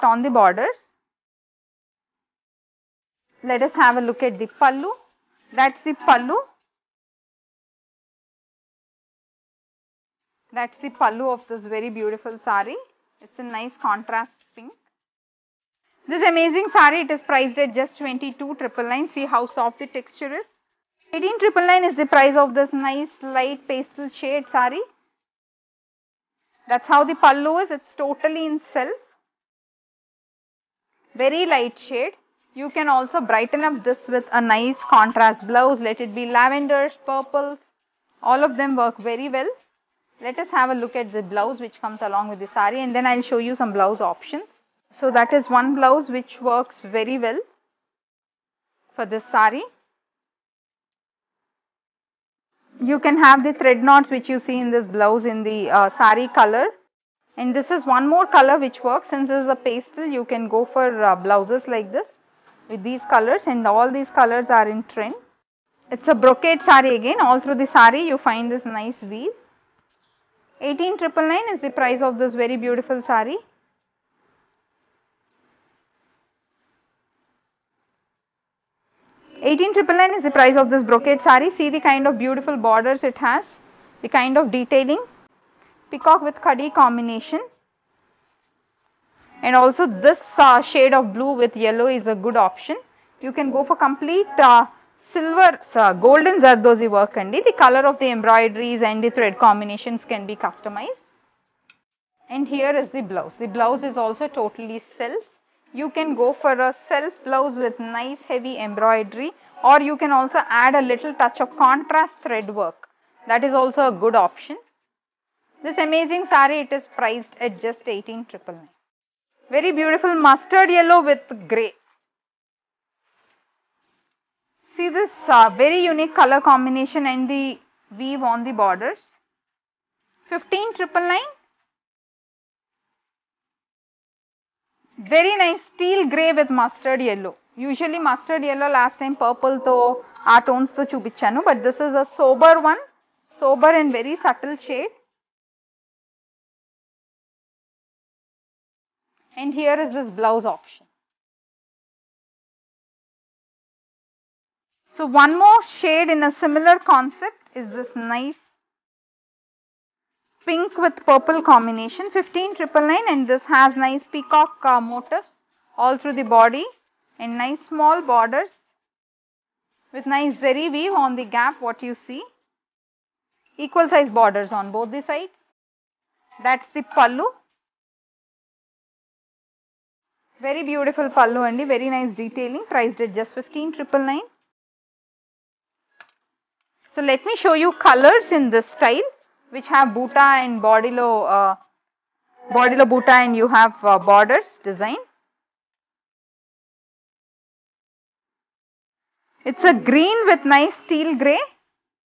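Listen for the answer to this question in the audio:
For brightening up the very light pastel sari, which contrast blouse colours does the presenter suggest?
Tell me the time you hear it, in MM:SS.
00:36.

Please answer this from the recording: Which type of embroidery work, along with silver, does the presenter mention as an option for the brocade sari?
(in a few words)
Golden zardozi.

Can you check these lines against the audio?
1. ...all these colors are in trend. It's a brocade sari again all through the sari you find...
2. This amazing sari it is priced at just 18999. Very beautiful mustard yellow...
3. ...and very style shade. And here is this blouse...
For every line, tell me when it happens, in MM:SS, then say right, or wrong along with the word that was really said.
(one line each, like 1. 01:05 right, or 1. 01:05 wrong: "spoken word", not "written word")
1. 01:03 right
2. 01:55 right
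3. 02:23 wrong: "subtle", not "style".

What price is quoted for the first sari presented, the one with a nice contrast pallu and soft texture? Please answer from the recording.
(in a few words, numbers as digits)
22,999.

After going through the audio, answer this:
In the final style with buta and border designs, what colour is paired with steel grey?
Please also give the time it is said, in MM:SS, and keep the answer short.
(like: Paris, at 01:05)
Green, at 03:19.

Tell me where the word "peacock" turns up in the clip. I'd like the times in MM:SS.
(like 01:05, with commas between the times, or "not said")
01:25, 02:44.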